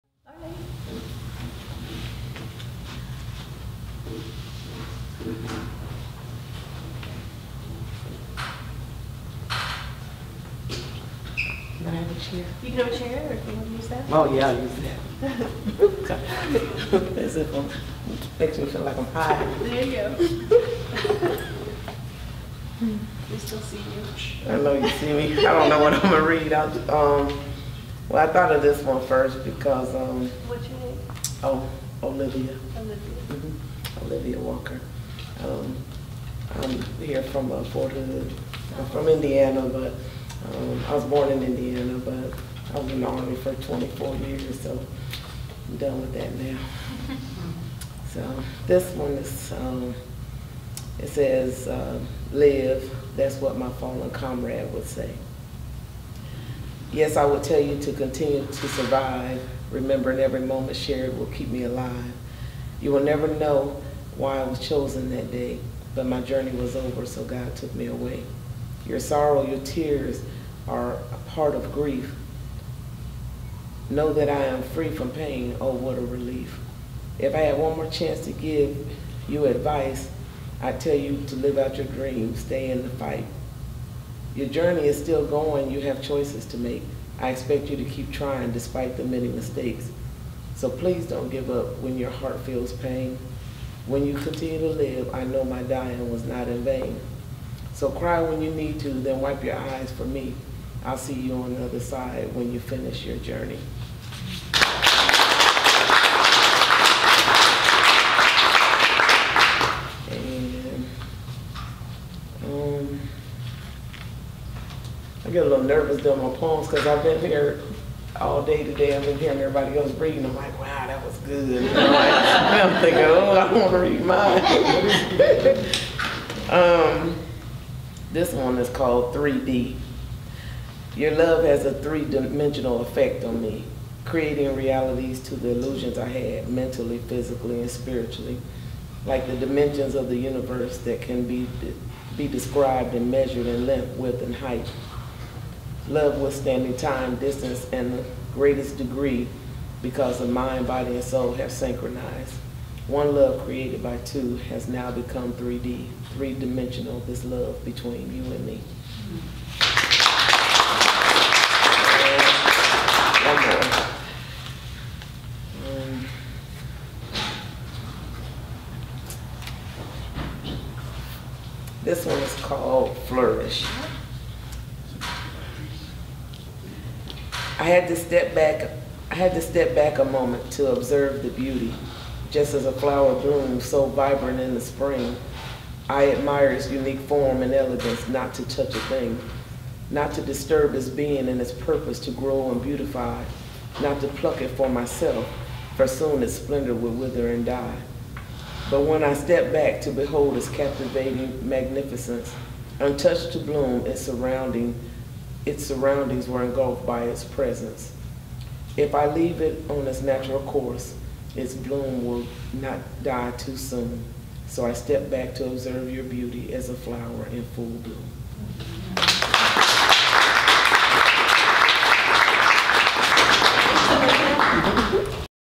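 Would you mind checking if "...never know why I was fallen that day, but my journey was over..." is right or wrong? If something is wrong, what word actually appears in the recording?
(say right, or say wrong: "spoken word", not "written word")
wrong: "chosen", not "fallen".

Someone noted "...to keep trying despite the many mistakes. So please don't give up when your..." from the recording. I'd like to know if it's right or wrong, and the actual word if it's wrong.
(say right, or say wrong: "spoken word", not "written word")
right.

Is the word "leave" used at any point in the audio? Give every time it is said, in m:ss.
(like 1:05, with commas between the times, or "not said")
3:29.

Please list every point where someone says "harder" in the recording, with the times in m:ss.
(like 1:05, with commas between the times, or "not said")
not said.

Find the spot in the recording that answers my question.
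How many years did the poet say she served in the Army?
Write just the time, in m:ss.
0:43.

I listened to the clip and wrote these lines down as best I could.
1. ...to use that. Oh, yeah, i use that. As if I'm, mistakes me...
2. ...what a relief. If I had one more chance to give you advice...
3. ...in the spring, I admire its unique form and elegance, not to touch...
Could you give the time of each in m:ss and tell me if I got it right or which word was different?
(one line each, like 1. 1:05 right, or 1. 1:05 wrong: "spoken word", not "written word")
1. 0:13 wrong: "makes", not "mistakes"
2. 1:15 right
3. 3:04 right.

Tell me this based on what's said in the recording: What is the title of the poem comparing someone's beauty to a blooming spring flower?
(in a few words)
Flourish.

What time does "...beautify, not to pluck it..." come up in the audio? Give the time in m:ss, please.
3:12.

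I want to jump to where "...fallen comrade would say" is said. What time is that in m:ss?
0:53.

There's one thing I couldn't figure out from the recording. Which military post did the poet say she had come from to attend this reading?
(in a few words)
Fort Hood.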